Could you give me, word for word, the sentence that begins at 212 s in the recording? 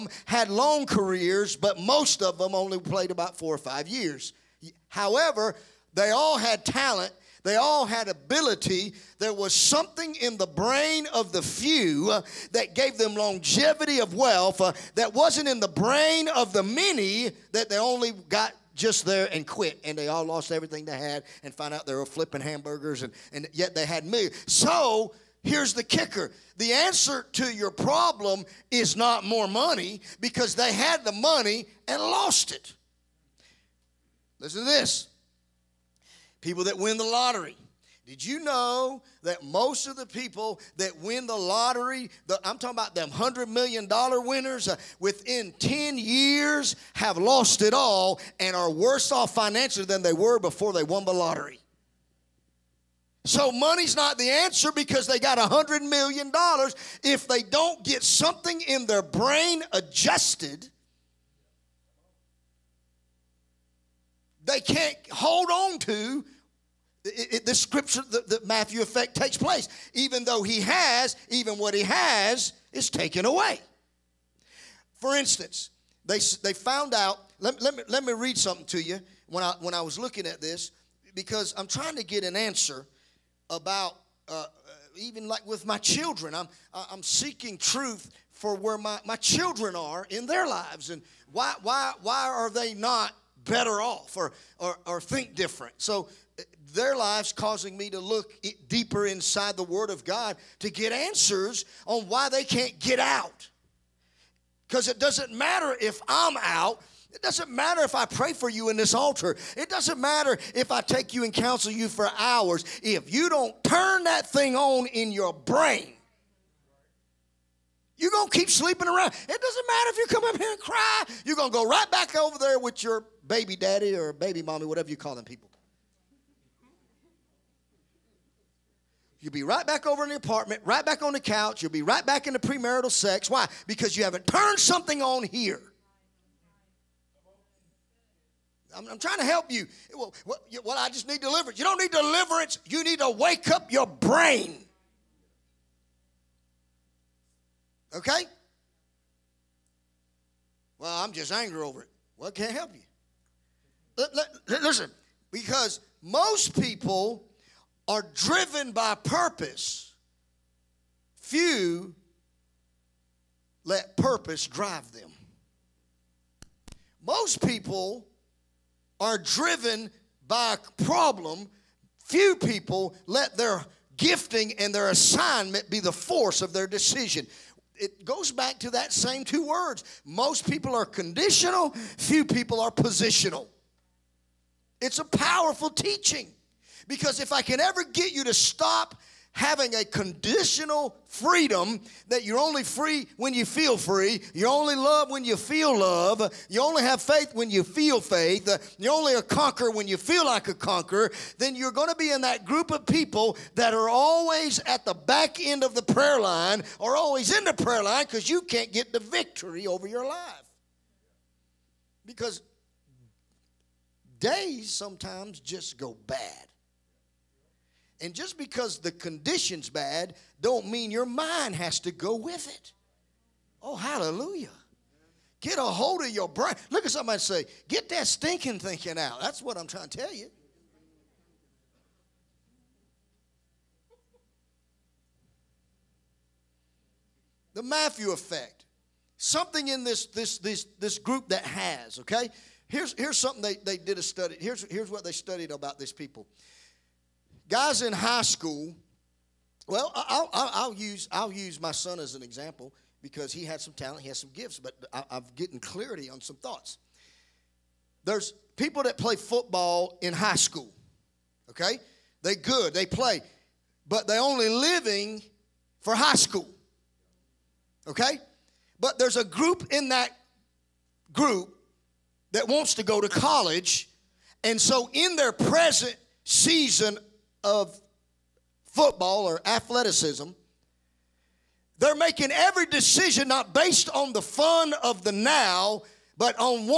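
Because days sometimes just go bad.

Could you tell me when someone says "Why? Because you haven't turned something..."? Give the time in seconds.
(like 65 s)
133 s.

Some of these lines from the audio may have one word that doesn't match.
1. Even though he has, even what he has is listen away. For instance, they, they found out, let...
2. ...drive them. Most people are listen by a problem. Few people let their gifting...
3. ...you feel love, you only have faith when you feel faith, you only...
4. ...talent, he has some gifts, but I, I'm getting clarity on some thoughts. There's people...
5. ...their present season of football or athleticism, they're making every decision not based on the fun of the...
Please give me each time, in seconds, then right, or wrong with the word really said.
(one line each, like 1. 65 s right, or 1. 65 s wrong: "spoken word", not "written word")
1. 69 s wrong: "taken", not "listen"
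2. 164 s wrong: "driven", not "listen"
3. 195 s right
4. 253 s right
5. 275 s right.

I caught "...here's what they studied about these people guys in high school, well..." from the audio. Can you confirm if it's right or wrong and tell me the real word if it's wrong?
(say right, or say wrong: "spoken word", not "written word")
right.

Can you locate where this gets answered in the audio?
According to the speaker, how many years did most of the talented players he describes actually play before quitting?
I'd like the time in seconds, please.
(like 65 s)
3 s.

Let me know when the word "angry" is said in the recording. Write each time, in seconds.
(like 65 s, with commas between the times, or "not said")
151 s.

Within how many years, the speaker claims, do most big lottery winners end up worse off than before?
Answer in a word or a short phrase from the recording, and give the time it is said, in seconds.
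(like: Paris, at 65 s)
10 years, at 45 s.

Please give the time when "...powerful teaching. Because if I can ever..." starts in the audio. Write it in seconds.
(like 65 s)
185 s.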